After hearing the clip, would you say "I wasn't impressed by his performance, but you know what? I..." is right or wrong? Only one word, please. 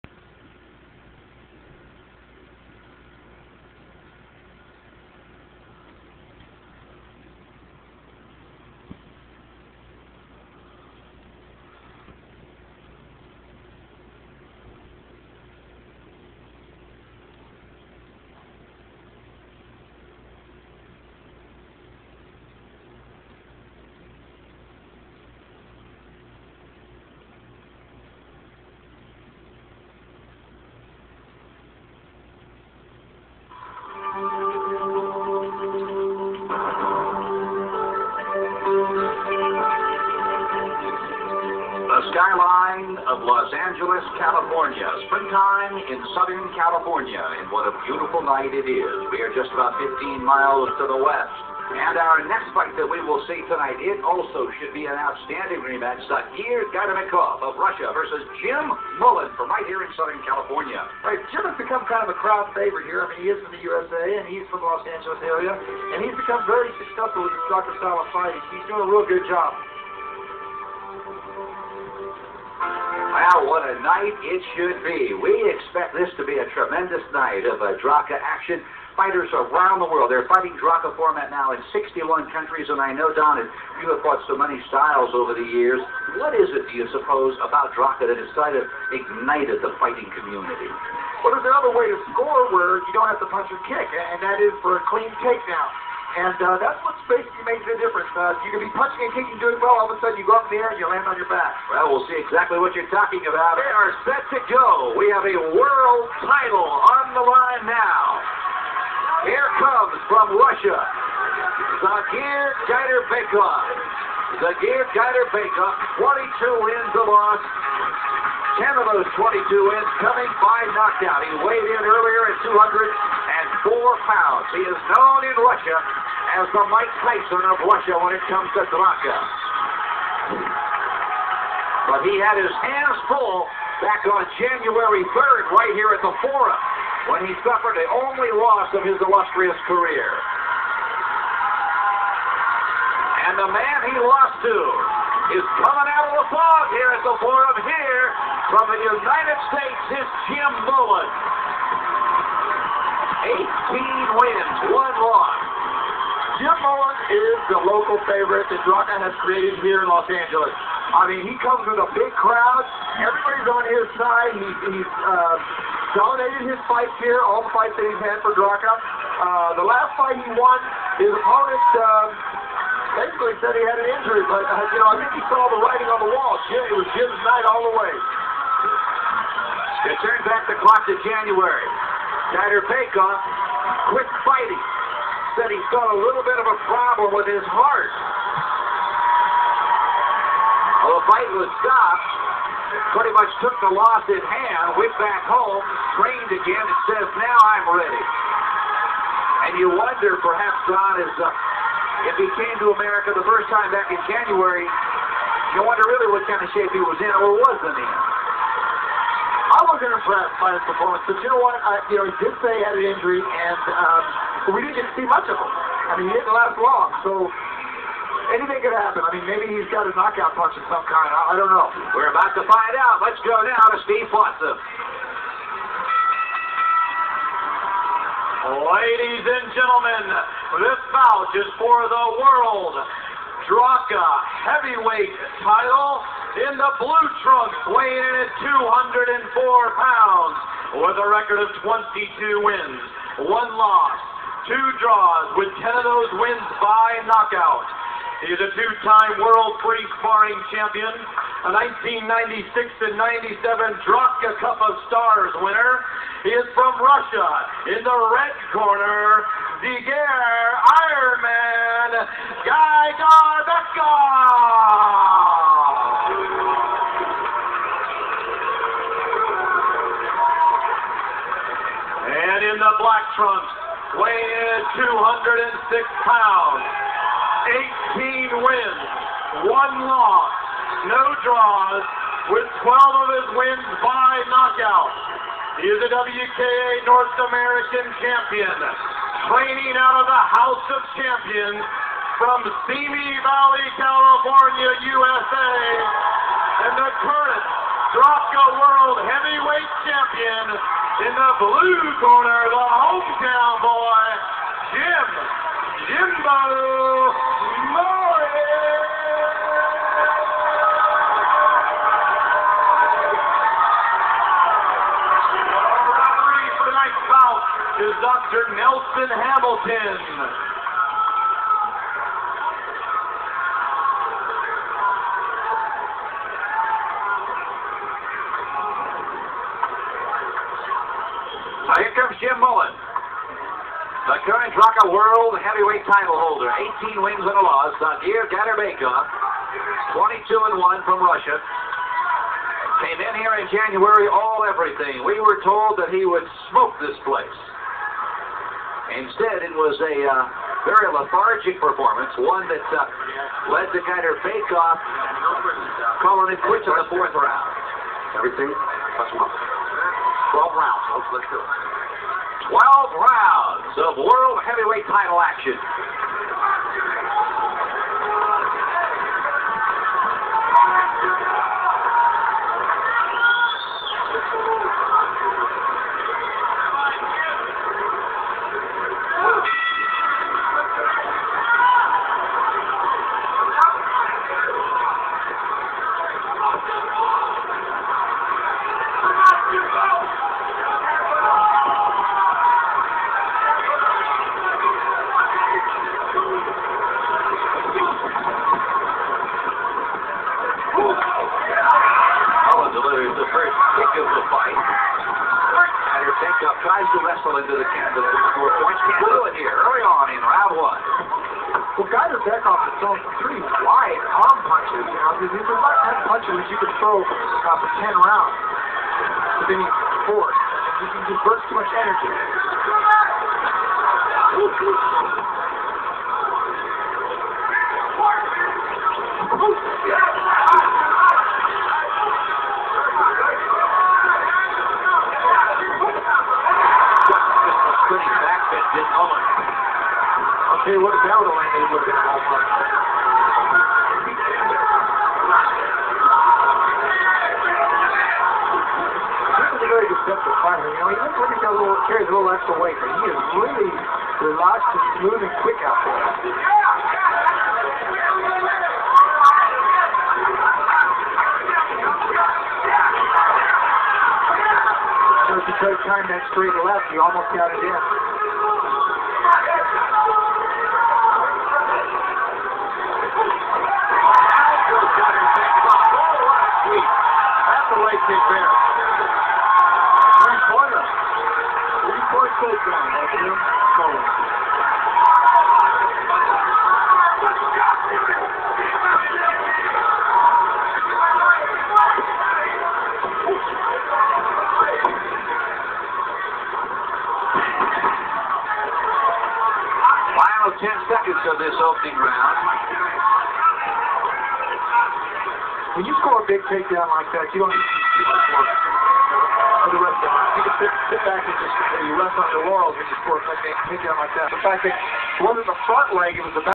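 right.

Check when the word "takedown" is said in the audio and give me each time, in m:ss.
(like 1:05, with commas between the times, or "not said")
1:35, 8:26, 8:33.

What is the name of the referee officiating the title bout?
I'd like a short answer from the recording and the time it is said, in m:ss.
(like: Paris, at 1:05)
Dr. Nelson Hamilton, at 5:17.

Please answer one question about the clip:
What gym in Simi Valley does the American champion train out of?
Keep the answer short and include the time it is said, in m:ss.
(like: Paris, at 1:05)
House of Champions, at 4:50.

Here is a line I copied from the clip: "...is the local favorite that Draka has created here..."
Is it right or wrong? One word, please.
right.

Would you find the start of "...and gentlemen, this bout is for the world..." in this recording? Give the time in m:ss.
3:49.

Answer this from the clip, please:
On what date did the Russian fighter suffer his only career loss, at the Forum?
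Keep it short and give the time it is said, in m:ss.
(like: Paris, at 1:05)
January 3rd, at 2:14.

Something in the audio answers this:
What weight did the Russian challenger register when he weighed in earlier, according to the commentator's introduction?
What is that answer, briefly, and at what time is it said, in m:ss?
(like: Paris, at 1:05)
204 pounds, at 2:01.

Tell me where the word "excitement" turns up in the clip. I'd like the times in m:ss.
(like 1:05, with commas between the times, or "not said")
not said.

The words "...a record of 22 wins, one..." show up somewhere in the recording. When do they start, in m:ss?
4:00.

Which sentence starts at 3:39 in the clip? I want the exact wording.
I mean, maybe he's got a knockout punch of some kind.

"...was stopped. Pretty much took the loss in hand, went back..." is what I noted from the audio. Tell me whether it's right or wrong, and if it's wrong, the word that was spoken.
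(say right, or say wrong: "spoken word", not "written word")
right.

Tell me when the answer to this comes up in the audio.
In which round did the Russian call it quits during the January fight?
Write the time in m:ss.
5:56.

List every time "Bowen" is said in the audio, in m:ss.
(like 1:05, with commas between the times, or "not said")
2:30.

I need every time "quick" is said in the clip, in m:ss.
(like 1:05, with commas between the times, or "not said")
3:03, 7:35.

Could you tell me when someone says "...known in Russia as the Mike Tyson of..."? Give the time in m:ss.
2:04.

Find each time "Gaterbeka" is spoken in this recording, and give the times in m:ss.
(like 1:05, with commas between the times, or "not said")
5:38, 5:53.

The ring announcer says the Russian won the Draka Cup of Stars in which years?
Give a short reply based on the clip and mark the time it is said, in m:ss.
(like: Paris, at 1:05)
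1996 and 1997, at 4:12.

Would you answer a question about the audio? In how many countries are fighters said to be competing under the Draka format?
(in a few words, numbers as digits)
61.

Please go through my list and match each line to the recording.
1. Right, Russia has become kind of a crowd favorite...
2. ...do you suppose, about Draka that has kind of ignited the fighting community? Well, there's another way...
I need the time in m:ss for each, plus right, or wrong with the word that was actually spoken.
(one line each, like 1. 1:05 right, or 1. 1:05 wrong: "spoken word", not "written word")
1. 1:01 wrong: "Jim", not "Russia"
2. 1:26 right.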